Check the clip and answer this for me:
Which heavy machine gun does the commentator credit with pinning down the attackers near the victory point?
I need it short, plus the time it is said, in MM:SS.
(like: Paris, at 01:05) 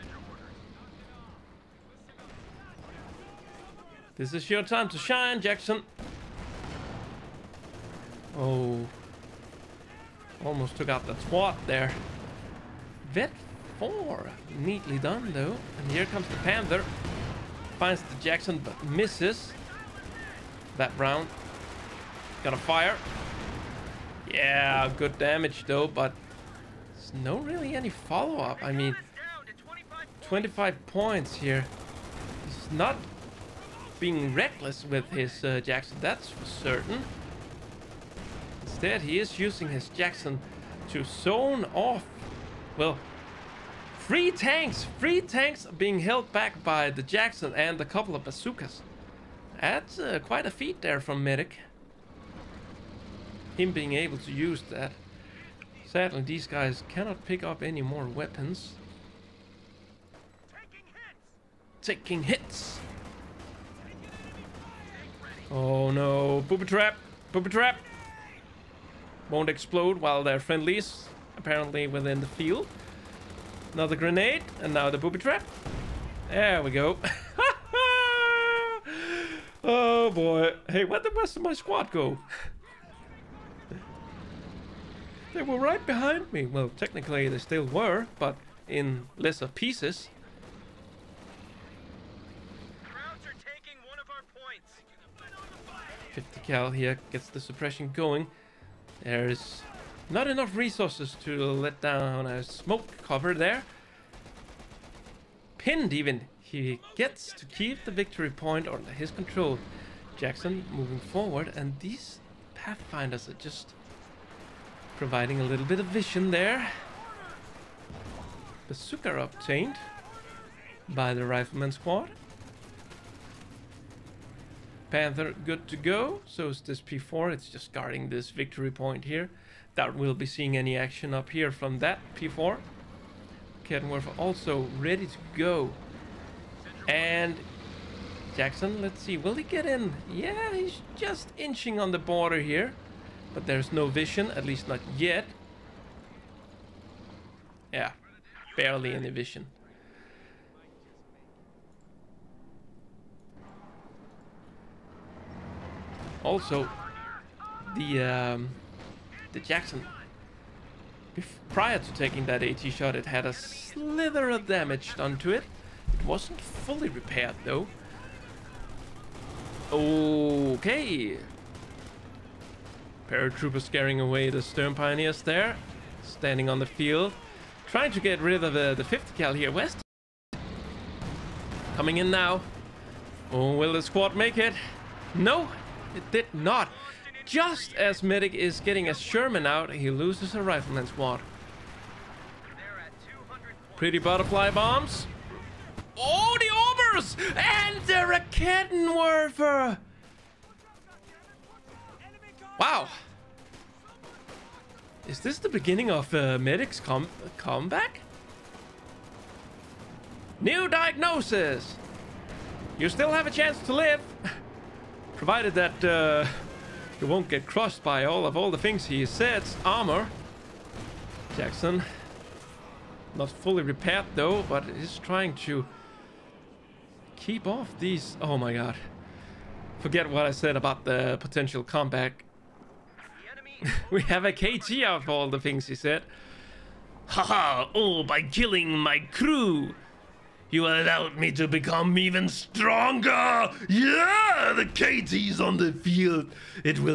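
Fifty cal, at 01:36.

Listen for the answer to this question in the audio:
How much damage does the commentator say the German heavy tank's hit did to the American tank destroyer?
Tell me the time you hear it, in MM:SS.
00:30.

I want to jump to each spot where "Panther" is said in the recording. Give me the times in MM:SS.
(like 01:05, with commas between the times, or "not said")
00:16, 02:04.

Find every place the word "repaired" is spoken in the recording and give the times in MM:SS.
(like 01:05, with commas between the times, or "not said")
02:46, 03:43.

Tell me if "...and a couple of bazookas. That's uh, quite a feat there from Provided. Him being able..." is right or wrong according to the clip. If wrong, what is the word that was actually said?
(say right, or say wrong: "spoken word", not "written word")
wrong: "Medic", not "Provided".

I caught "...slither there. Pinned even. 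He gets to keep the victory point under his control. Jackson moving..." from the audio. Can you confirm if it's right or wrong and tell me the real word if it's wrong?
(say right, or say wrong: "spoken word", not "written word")
wrong: "cover", not "slither".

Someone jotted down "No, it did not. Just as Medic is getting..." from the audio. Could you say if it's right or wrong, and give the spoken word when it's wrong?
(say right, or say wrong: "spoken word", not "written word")
right.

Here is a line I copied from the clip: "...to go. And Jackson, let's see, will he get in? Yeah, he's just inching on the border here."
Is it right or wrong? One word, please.
right.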